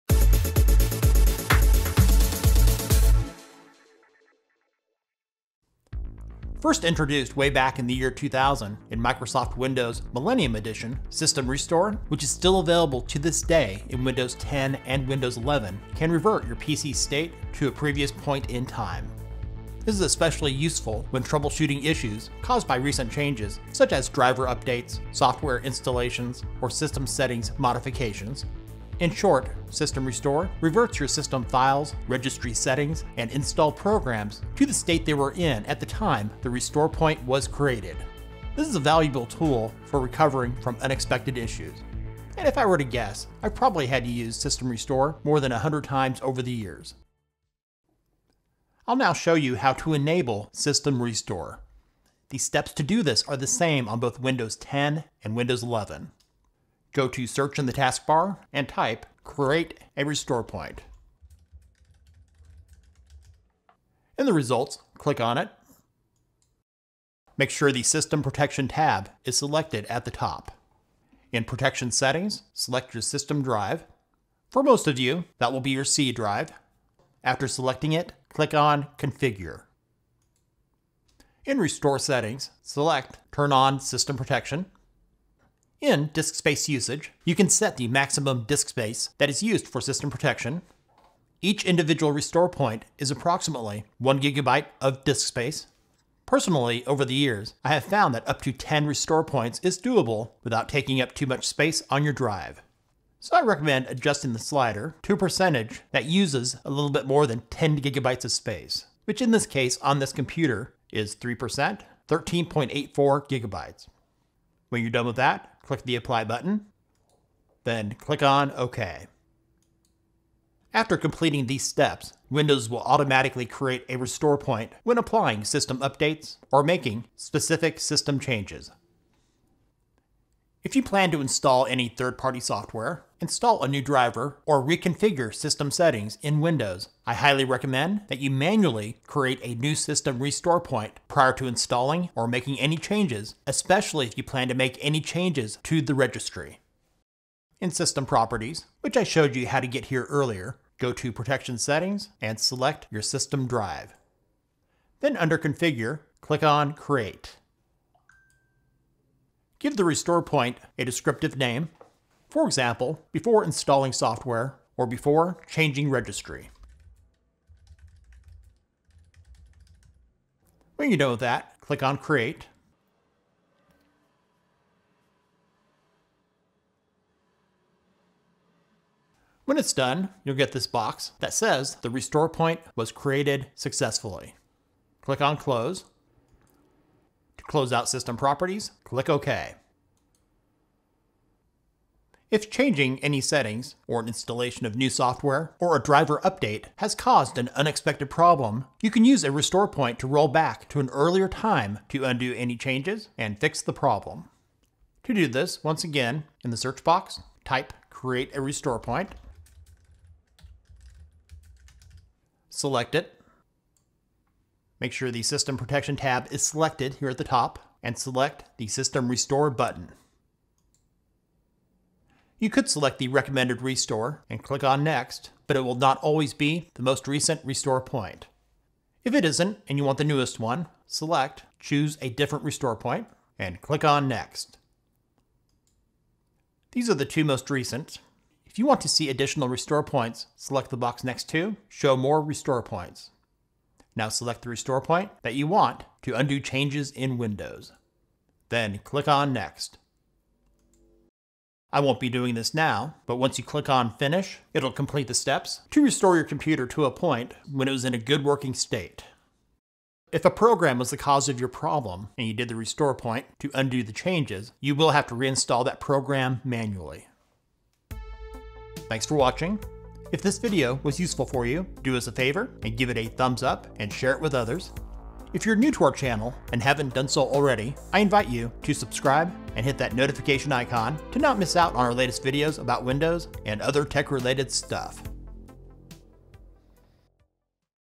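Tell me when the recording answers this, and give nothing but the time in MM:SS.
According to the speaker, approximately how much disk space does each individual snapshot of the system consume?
01:33.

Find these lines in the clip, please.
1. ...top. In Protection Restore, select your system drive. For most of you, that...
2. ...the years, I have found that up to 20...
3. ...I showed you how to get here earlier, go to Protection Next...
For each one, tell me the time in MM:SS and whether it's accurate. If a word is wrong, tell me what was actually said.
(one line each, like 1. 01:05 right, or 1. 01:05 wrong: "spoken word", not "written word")
1. 01:10 wrong: "Settings", not "Restore"
2. 01:37 wrong: "10", not "20"
3. 02:28 wrong: "Settings", not "Next".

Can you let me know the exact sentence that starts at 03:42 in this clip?
You could select the recommended restore and click on Next, but it will not always be the most recent restore point.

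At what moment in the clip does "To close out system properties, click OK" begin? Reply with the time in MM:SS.
03:07.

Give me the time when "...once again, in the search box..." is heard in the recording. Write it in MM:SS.
03:25.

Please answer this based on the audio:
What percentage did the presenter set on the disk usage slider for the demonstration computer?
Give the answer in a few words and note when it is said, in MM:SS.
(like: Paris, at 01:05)
3%, at 01:51.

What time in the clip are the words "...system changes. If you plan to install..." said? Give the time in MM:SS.
02:07.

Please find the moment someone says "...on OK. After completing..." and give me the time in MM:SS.
01:58.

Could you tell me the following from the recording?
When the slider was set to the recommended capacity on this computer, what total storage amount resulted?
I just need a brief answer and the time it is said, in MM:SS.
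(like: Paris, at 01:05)
13.84 gigabytes, at 01:52.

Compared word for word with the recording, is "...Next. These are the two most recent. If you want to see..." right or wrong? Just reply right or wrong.
right.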